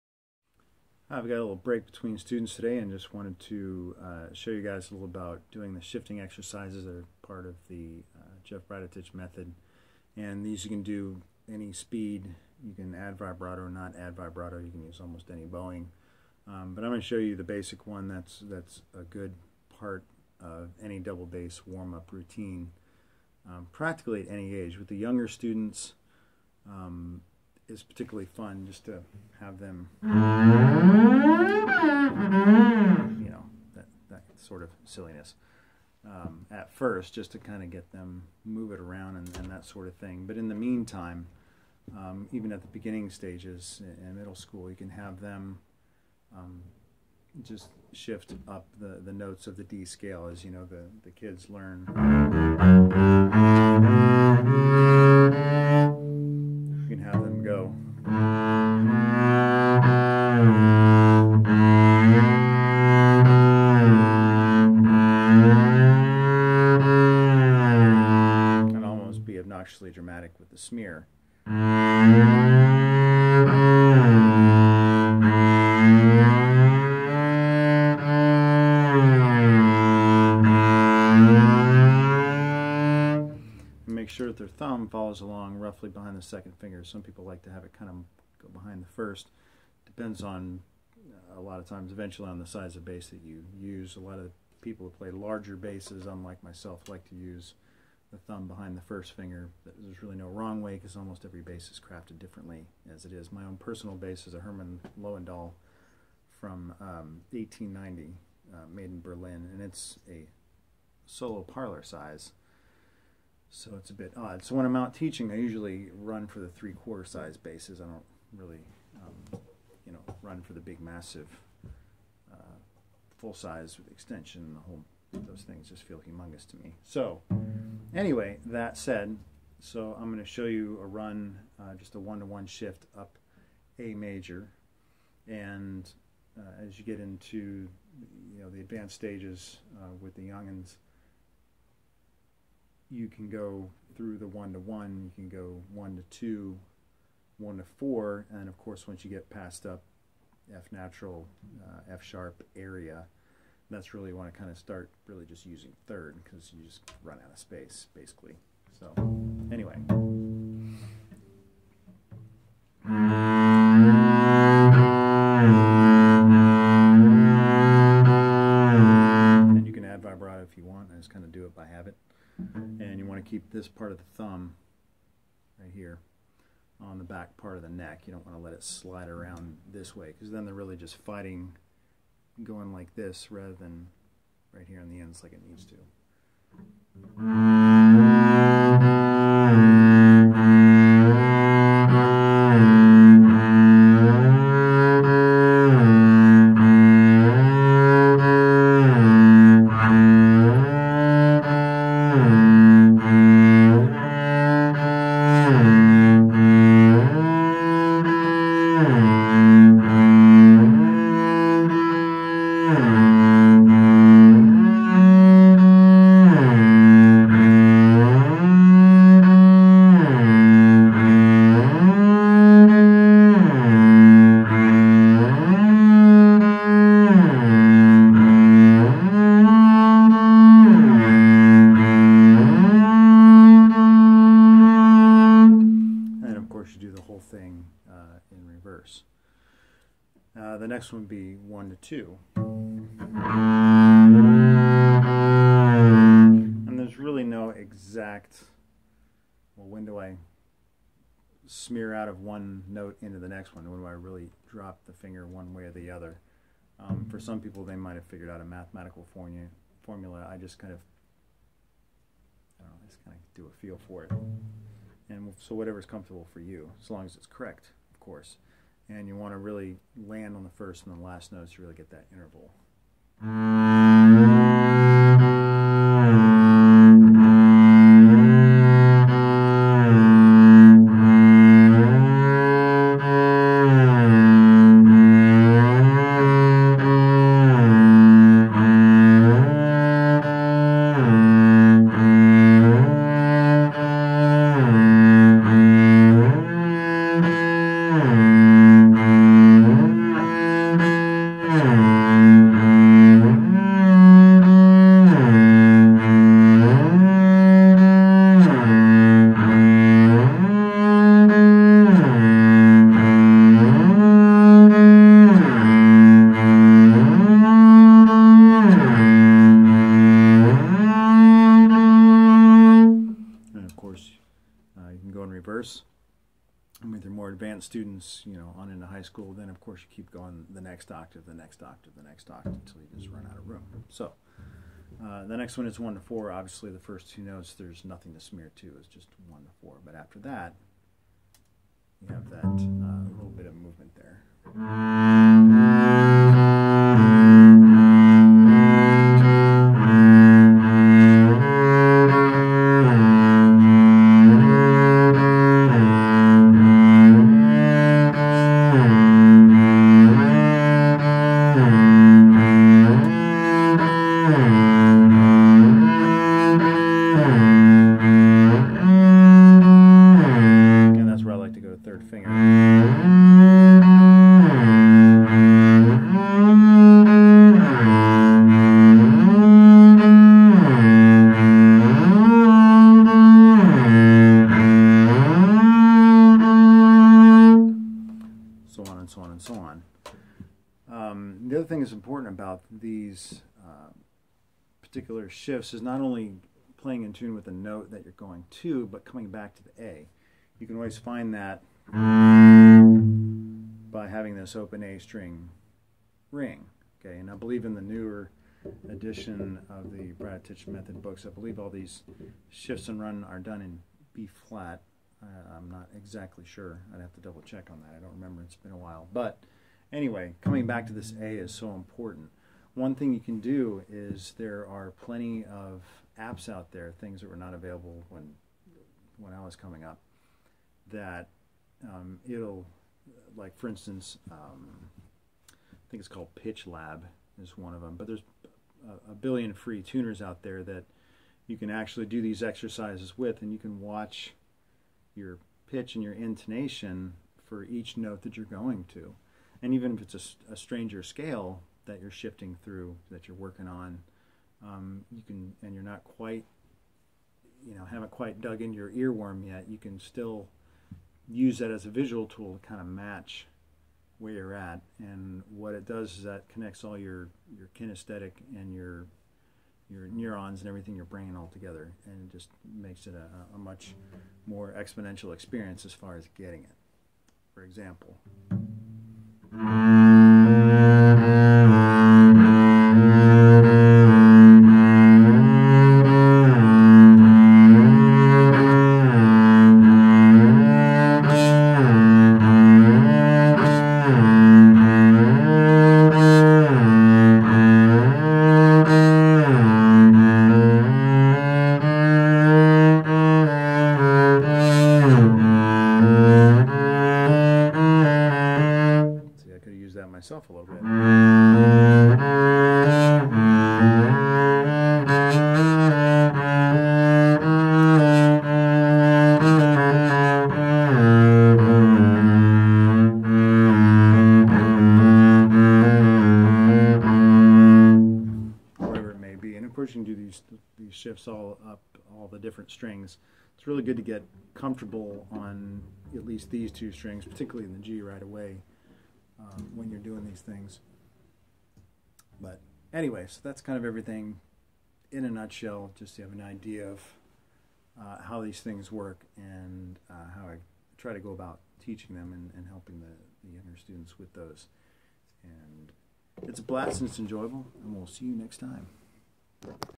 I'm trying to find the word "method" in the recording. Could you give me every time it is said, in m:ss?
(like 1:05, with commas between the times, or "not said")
0:09, 6:50.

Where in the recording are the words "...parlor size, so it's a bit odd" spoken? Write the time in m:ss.
1:51.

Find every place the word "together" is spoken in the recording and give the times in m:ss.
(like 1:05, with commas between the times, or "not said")
7:51.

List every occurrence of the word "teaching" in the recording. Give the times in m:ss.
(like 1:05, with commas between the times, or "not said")
1:54, 9:11.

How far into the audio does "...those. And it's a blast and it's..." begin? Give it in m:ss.
9:14.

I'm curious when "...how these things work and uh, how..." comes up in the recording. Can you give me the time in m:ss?
9:08.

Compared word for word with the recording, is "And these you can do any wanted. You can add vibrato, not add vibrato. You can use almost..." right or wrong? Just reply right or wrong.
wrong.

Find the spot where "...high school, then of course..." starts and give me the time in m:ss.
5:28.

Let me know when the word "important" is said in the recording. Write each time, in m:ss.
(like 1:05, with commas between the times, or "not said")
6:31, 7:01.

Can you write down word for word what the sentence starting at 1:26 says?
Some people like to have it kind of go behind the first.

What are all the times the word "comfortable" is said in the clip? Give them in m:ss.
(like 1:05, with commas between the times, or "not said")
4:25, 8:54.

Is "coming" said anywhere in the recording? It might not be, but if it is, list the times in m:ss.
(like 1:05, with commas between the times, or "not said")
6:39, 7:00, 7:09.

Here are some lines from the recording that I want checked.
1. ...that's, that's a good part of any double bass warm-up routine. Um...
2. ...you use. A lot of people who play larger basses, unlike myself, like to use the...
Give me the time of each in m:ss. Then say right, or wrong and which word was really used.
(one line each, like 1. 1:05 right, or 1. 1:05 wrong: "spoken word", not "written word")
1. 0:18 right
2. 1:33 right.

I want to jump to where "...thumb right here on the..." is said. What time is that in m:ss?
2:54.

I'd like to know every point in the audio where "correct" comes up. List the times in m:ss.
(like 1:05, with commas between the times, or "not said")
4:27.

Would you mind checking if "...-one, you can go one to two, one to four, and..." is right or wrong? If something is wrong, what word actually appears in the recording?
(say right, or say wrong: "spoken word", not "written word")
right.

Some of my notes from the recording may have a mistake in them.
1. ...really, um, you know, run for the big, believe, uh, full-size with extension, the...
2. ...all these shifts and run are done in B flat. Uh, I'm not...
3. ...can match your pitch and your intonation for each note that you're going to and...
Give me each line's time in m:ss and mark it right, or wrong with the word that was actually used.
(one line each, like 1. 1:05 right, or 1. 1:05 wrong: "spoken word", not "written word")
1. 1:58 wrong: "massive", not "believe"
2. 6:51 right
3. 7:23 wrong: "watch", not "match".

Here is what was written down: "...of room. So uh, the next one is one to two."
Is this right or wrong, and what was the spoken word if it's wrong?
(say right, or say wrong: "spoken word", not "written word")
wrong: "four", not "two".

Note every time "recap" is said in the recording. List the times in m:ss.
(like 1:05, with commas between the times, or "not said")
not said.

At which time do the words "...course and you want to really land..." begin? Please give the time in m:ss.
4:27.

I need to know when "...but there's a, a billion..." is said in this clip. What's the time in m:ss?
7:17.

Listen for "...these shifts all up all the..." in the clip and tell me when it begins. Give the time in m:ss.
8:50.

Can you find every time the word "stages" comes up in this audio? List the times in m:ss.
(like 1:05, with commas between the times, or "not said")
0:43, 2:18.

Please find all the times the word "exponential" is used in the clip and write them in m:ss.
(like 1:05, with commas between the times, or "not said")
7:54.